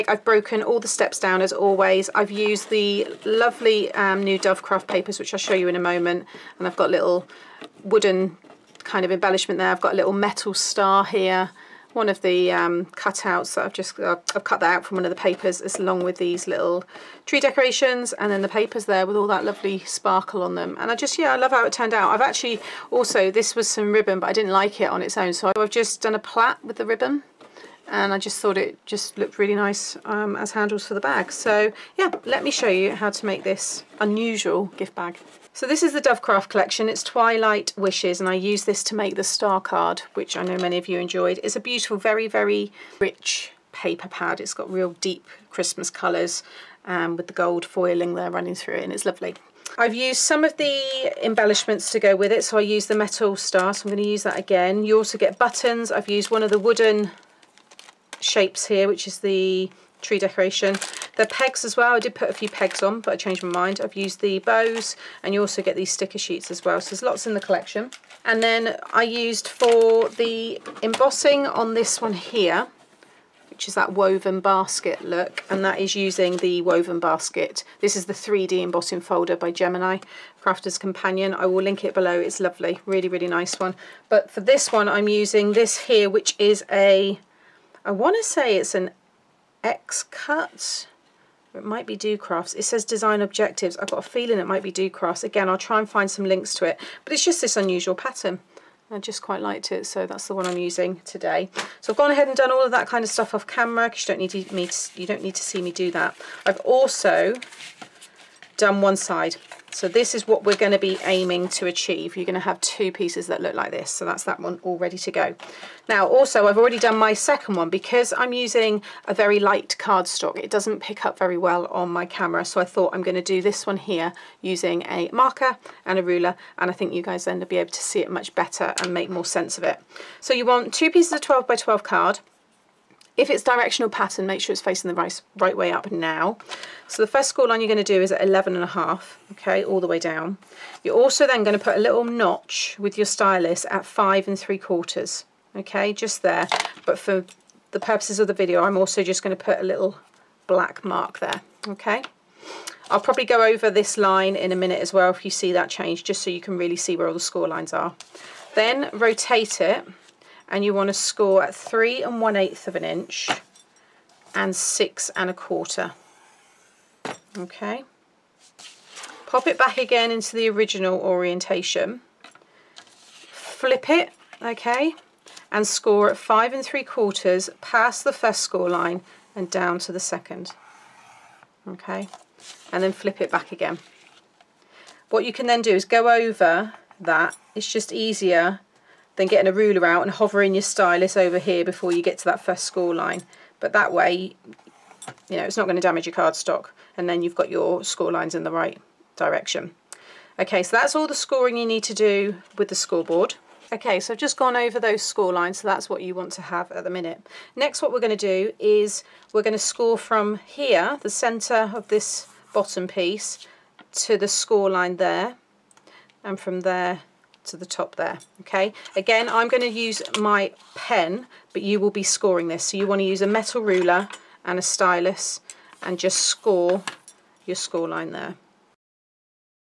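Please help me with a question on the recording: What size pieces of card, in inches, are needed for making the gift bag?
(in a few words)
12 by 12.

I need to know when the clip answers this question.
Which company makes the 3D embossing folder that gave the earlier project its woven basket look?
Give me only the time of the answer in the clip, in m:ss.
1:19.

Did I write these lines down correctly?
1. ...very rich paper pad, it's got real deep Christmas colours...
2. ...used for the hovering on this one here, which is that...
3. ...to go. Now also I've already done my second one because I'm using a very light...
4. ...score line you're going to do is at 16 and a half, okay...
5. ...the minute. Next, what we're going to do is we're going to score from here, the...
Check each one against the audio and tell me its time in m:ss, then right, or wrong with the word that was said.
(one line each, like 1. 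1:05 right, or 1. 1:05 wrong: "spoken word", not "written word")
1. 0:42 right
2. 1:09 wrong: "embossing", not "hovering"
3. 1:54 right
4. 2:17 wrong: "11", not "16"
5. 3:26 right.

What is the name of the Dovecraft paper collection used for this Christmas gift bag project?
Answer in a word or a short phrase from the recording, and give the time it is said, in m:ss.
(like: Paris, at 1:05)
Twilight Wishes, at 0:37.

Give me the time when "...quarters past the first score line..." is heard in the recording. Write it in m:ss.
2:56.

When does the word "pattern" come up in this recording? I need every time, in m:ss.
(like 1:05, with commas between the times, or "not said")
1:37, 2:13.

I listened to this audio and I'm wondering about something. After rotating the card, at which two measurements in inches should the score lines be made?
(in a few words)
3 1/8 and 6 1/4.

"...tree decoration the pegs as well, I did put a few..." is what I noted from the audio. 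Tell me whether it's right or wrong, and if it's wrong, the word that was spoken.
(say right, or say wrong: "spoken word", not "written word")
right.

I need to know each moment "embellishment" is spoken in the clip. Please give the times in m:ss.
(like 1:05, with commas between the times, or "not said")
0:09, 0:51.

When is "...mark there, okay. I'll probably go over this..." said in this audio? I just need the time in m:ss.
2:30.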